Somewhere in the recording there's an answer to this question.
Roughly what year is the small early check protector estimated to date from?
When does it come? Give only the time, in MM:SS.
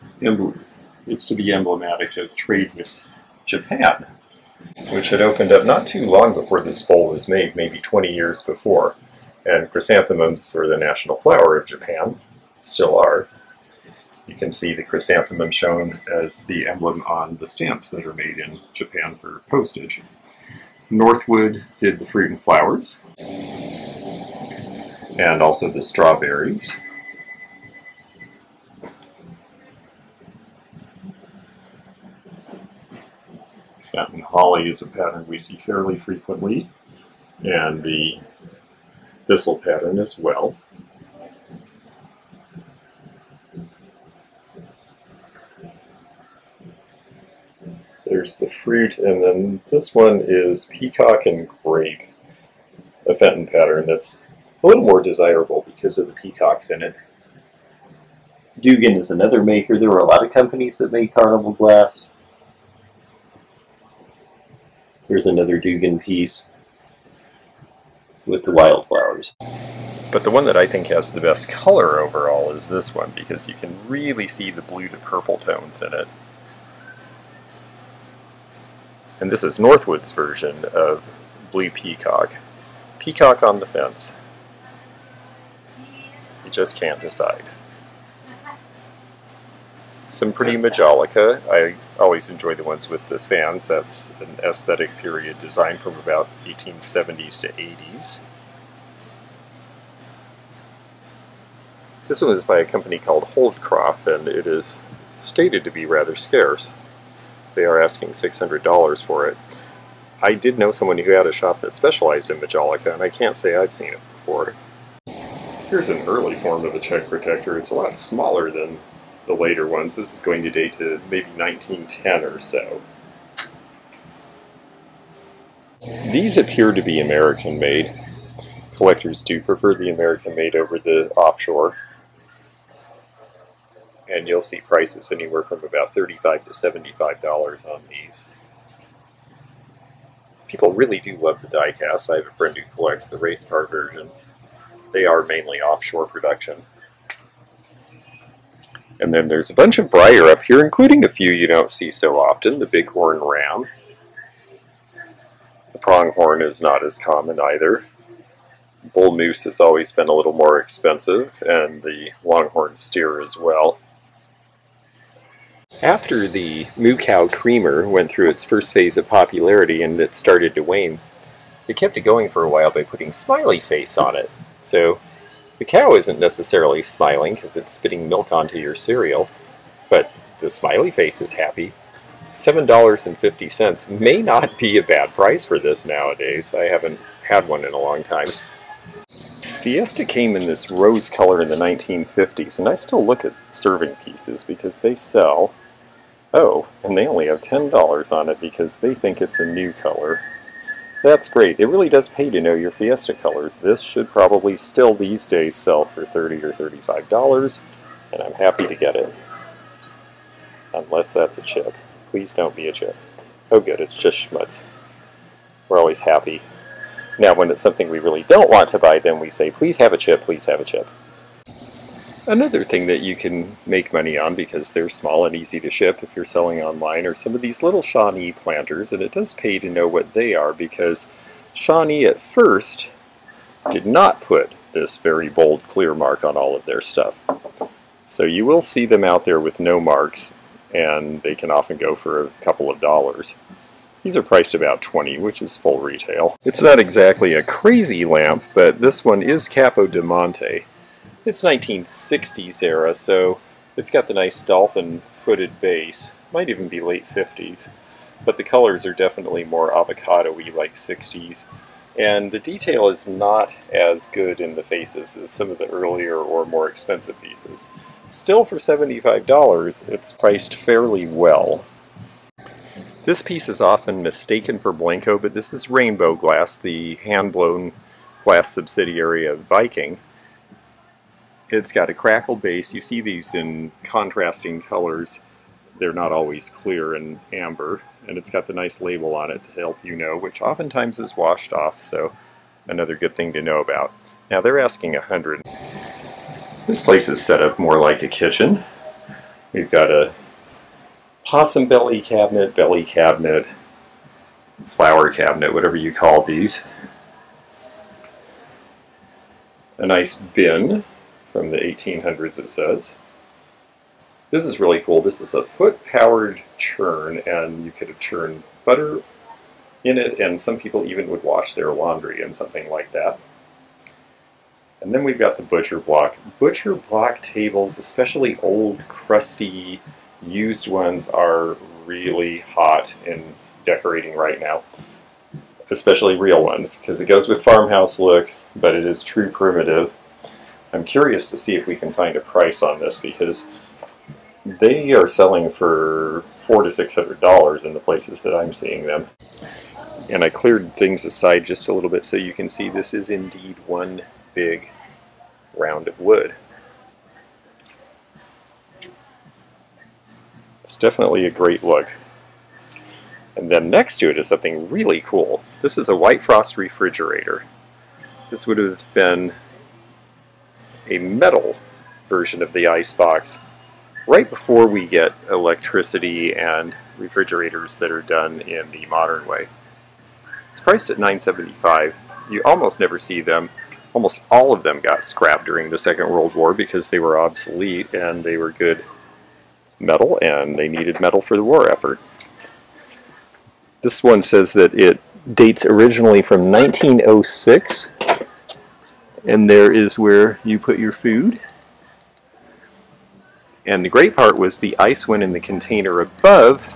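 02:01.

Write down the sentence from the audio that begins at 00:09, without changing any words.
And chrysanthemums are the national flower of Japan, still are.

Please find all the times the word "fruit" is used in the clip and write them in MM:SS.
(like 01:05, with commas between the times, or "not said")
00:22, 00:48.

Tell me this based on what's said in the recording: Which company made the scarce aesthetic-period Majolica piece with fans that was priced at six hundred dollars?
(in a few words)
Holdcroft.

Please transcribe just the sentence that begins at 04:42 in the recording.
You see these in contrasting colors.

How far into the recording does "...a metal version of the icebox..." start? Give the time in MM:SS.
06:10.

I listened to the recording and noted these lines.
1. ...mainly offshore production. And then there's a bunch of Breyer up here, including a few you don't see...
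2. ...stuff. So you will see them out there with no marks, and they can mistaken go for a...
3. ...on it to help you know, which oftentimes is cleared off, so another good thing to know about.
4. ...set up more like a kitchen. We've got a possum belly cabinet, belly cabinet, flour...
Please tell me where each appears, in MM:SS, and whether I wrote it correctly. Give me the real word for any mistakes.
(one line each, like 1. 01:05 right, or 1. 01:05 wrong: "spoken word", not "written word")
1. 02:25 right
2. 03:56 wrong: "often", not "mistaken"
3. 04:49 wrong: "washed", not "cleared"
4. 04:57 right.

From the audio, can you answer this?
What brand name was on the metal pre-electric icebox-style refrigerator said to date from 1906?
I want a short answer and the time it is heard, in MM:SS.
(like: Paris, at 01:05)
White Frost, at 06:05.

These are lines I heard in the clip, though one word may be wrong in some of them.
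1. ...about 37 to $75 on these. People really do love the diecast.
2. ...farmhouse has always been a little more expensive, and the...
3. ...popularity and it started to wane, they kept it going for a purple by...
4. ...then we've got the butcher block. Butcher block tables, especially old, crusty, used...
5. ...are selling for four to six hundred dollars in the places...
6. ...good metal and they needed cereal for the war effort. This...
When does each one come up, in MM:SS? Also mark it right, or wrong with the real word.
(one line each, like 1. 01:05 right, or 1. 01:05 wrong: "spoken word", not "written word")
1. 02:15 wrong: "35", not "37"
2. 02:39 wrong: "moose", not "farmhouse"
3. 02:49 wrong: "while", not "purple"
4. 05:24 right
5. 05:44 right
6. 06:28 wrong: "metal", not "cereal".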